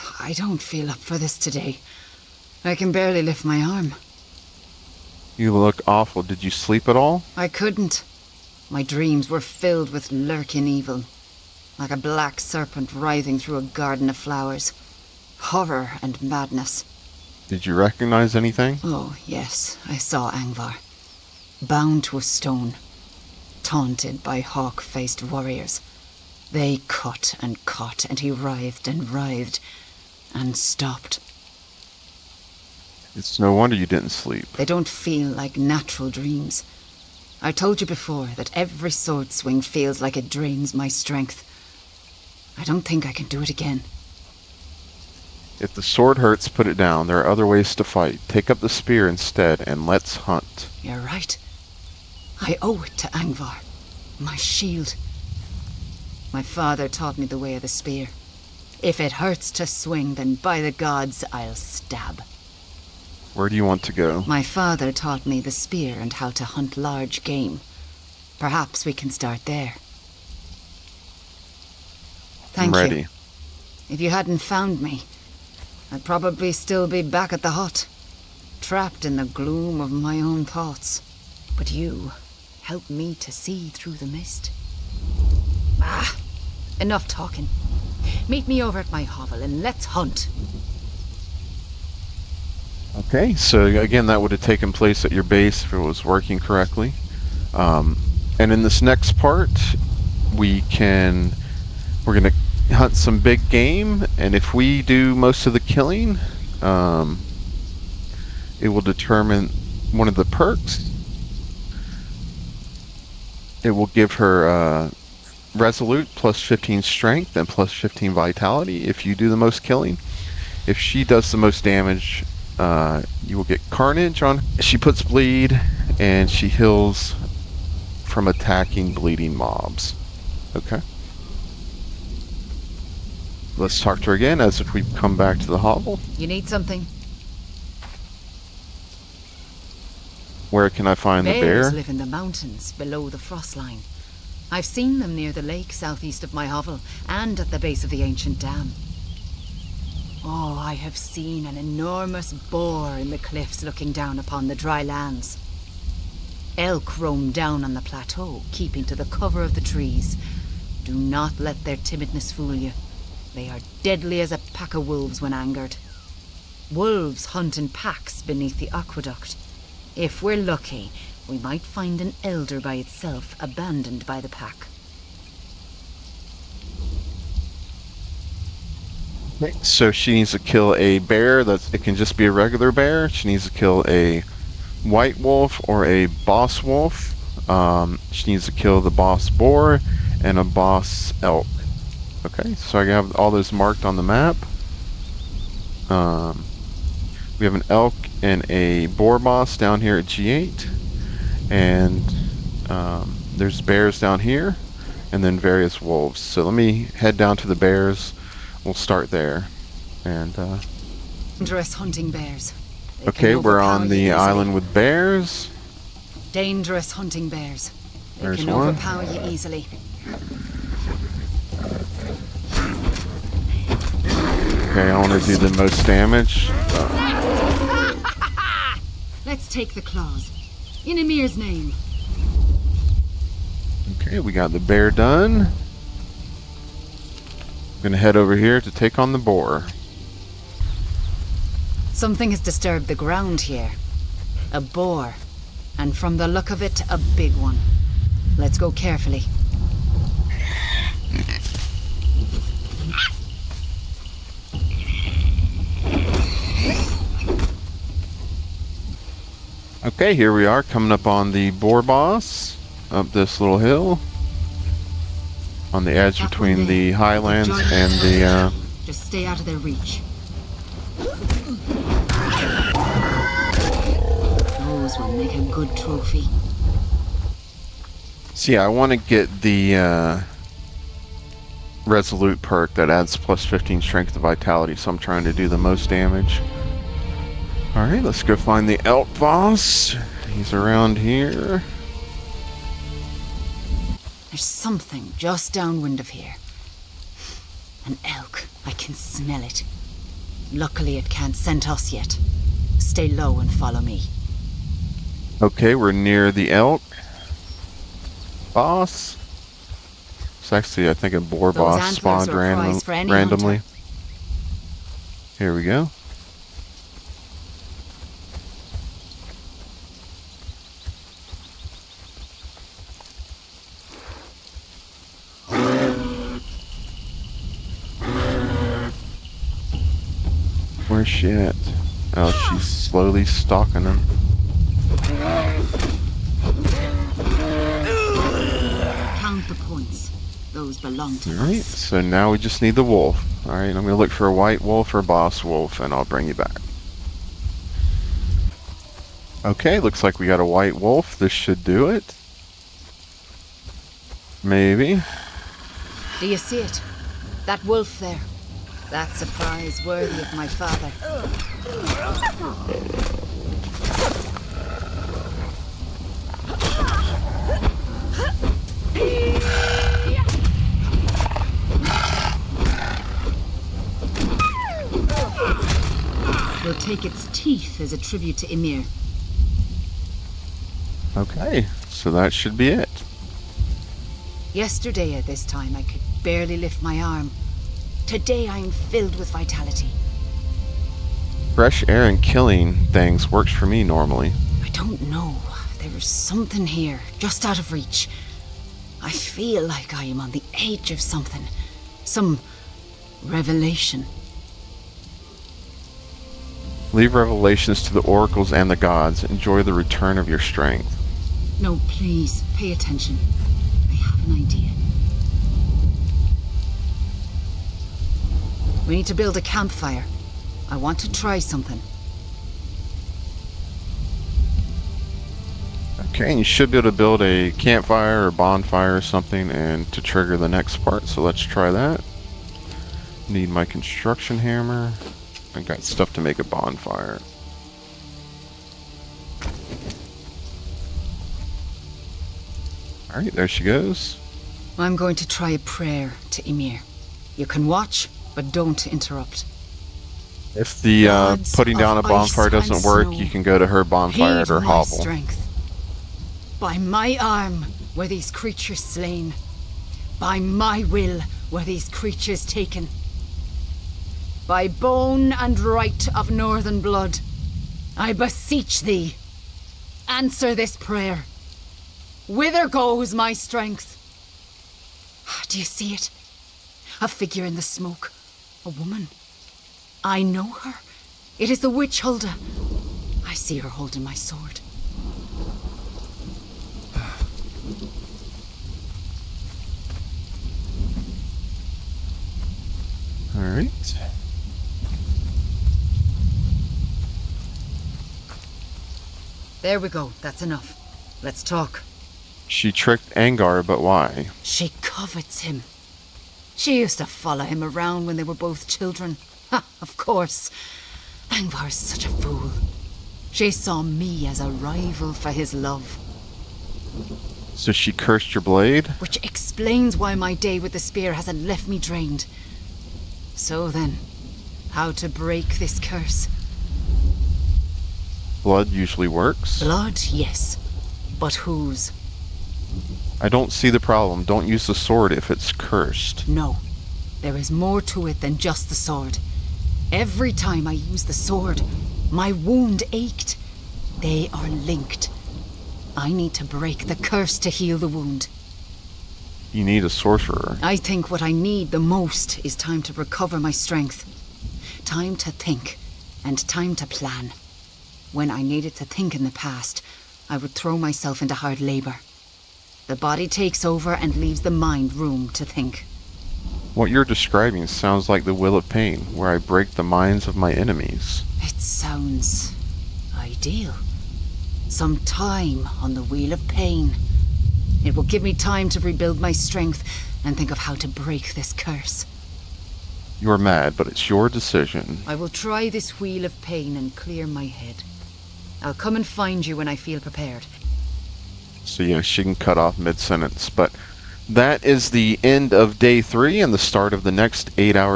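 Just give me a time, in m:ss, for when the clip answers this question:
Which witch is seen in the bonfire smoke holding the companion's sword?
8:01.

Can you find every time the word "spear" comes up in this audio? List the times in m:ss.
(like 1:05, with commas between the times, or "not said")
0:48, 0:57, 1:05, 8:40.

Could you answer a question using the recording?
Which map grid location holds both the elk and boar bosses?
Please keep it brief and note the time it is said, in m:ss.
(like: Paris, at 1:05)
G8, at 3:20.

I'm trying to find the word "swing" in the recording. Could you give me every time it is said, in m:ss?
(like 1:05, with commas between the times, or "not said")
0:39, 0:59.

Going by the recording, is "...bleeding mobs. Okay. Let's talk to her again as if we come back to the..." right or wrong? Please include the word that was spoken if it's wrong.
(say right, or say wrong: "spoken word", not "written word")
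right.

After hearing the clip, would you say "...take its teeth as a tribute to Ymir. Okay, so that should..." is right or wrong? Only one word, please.
right.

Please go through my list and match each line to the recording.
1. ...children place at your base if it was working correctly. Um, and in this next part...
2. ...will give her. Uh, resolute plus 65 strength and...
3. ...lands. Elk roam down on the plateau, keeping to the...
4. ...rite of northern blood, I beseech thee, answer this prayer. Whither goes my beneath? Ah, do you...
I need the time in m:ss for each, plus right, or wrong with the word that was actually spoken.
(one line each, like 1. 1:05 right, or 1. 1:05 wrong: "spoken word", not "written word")
1. 1:34 wrong: "taken", not "children"
2. 1:53 wrong: "15", not "65"
3. 2:34 right
4. 7:45 wrong: "strength", not "beneath".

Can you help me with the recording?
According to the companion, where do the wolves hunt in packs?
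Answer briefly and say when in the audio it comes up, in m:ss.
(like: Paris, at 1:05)
Beneath the aqueduct, at 2:48.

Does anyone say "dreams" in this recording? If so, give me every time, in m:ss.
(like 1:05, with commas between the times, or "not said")
0:08, 0:36.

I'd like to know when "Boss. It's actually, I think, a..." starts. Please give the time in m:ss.
5:08.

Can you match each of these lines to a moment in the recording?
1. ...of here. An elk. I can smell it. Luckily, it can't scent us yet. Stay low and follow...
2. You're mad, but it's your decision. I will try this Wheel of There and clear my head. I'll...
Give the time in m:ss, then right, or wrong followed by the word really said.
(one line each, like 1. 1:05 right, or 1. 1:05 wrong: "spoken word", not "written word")
1. 4:55 right
2. 9:43 wrong: "Pain", not "There".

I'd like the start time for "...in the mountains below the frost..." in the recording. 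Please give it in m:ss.
2:21.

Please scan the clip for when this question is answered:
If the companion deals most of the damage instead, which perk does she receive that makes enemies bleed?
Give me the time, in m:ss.
2:03.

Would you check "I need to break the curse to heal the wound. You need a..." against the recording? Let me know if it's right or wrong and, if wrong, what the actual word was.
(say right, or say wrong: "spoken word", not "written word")
right.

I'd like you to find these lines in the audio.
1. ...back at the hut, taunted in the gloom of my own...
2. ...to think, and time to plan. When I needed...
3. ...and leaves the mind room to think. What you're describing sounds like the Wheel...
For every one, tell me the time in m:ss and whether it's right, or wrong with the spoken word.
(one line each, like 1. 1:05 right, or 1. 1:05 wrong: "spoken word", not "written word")
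1. 1:17 wrong: "trapped", not "taunted"
2. 9:15 right
3. 9:23 right.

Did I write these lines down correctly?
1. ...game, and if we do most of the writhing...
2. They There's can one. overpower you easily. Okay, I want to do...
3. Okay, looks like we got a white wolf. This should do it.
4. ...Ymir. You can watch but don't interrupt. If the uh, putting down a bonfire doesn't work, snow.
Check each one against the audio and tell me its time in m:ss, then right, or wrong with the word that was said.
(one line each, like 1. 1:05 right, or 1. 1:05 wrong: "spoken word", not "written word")
1. 1:43 wrong: "killing", not "writhing"
2. 3:38 right
3. 5:49 right
4. 7:26 right.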